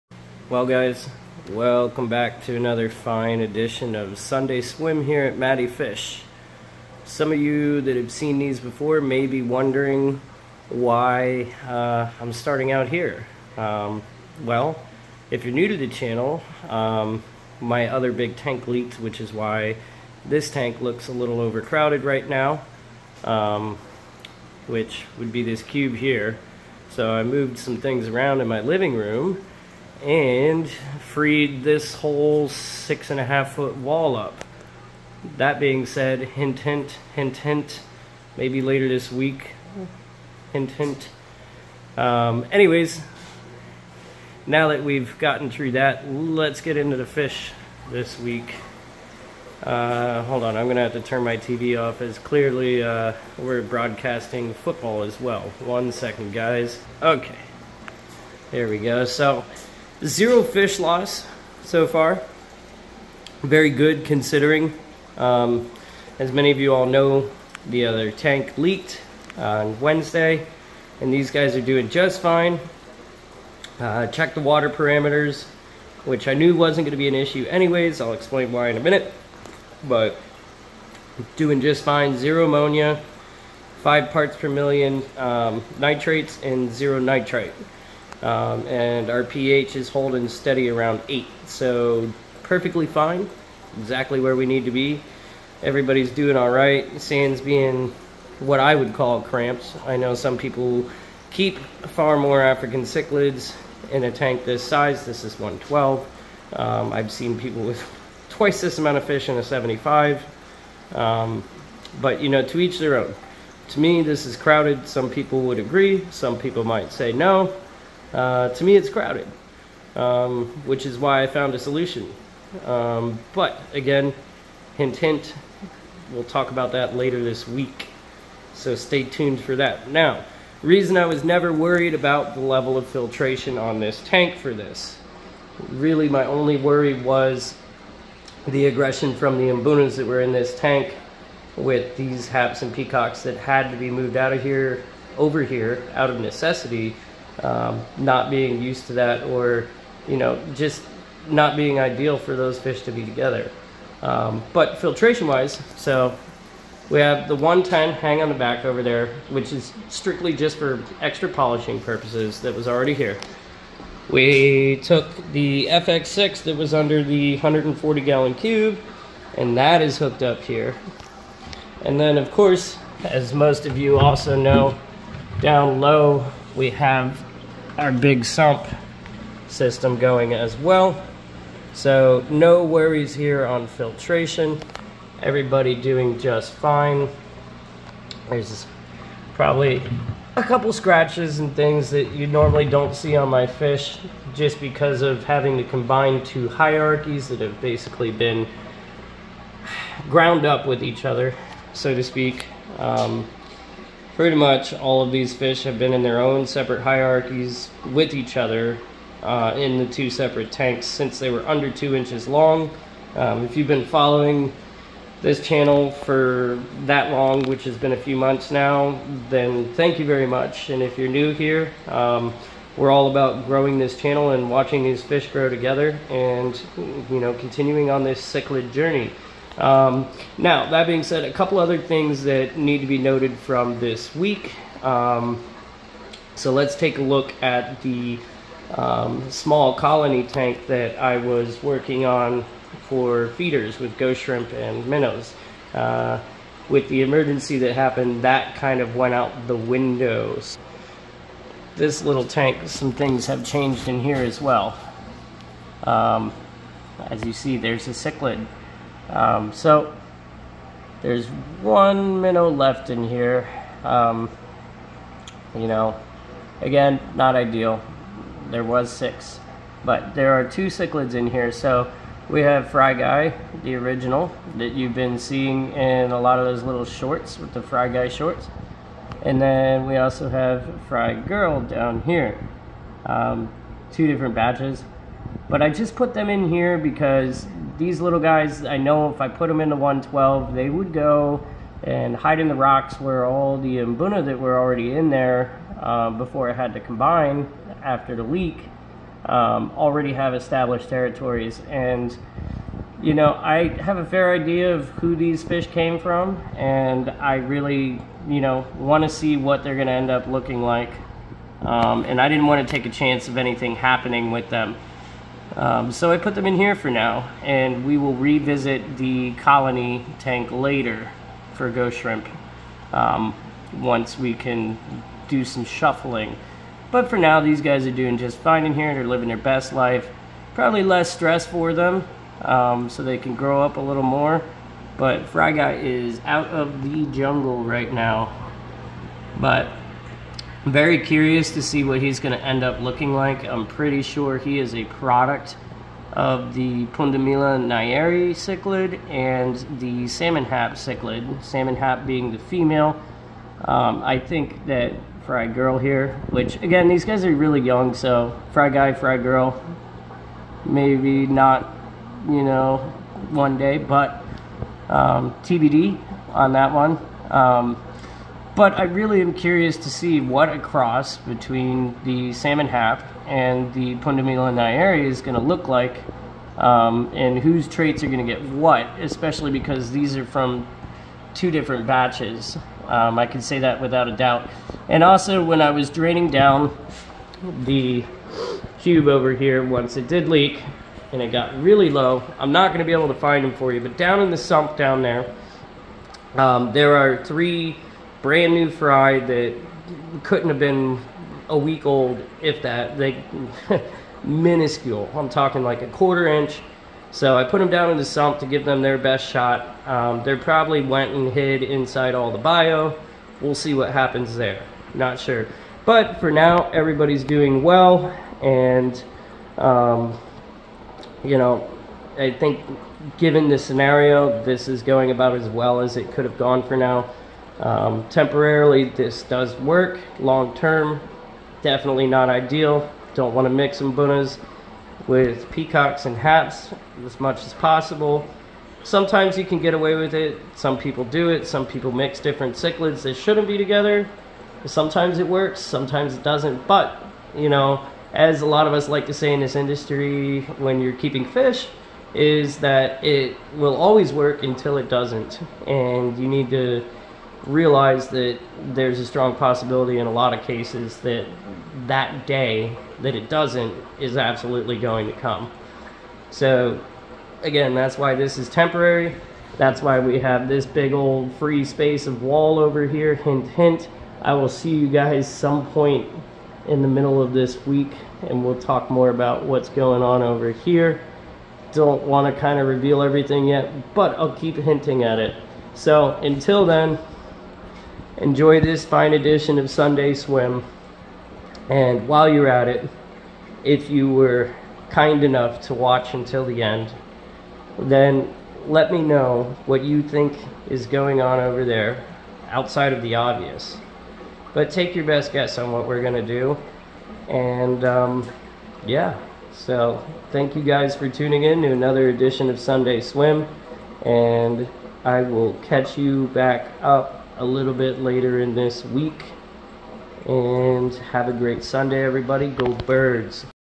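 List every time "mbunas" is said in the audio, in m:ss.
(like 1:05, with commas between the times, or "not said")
2:19, 4:53, 7:13.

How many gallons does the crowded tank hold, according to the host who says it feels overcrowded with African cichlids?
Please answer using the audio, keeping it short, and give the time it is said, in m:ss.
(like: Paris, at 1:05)
112, at 1:45.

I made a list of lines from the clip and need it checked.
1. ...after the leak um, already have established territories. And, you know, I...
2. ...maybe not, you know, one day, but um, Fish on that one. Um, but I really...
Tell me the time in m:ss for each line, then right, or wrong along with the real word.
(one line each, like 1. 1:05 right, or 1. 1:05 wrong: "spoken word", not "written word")
1. 4:57 right
2. 6:00 wrong: "TBD", not "Fish".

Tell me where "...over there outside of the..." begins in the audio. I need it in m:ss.
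8:21.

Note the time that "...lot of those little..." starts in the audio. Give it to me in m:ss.
4:36.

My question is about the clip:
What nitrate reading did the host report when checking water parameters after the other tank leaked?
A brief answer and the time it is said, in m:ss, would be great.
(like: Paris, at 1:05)
5 parts per million, at 1:23.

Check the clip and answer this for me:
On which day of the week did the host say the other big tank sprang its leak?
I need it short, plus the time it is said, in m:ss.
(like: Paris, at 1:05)
Wednesday, at 1:09.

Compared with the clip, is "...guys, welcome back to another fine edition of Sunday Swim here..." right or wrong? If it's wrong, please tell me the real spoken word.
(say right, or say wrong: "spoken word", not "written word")
right.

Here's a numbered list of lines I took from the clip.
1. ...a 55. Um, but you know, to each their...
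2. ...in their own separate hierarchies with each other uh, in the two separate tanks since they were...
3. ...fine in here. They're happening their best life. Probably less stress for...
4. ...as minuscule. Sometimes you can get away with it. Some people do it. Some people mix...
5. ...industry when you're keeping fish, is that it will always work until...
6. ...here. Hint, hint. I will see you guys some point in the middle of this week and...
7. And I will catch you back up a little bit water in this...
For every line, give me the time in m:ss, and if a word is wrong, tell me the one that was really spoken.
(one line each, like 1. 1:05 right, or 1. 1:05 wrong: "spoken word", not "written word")
1. 1:49 wrong: "75", not "55"
2. 3:25 right
3. 5:28 wrong: "living", not "happening"
4. 7:17 wrong: "possible", not "minuscule"
5. 7:29 right
6. 7:52 right
7. 8:34 wrong: "later", not "water".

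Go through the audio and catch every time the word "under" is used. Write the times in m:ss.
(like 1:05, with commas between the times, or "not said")
2:46, 3:31.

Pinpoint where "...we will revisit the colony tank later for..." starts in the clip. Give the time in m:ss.
5:17.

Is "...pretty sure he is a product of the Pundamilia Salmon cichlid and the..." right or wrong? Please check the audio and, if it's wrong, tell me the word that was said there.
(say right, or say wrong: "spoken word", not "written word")
wrong: "Nyeri", not "Salmon".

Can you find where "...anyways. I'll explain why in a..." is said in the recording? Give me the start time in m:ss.
1:17.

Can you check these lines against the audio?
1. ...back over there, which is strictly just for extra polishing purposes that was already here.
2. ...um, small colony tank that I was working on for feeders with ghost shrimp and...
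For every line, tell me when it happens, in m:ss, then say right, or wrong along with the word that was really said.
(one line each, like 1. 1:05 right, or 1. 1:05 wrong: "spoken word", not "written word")
1. 2:38 right
2. 3:58 right.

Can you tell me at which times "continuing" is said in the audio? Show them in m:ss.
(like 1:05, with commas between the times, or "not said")
3:47.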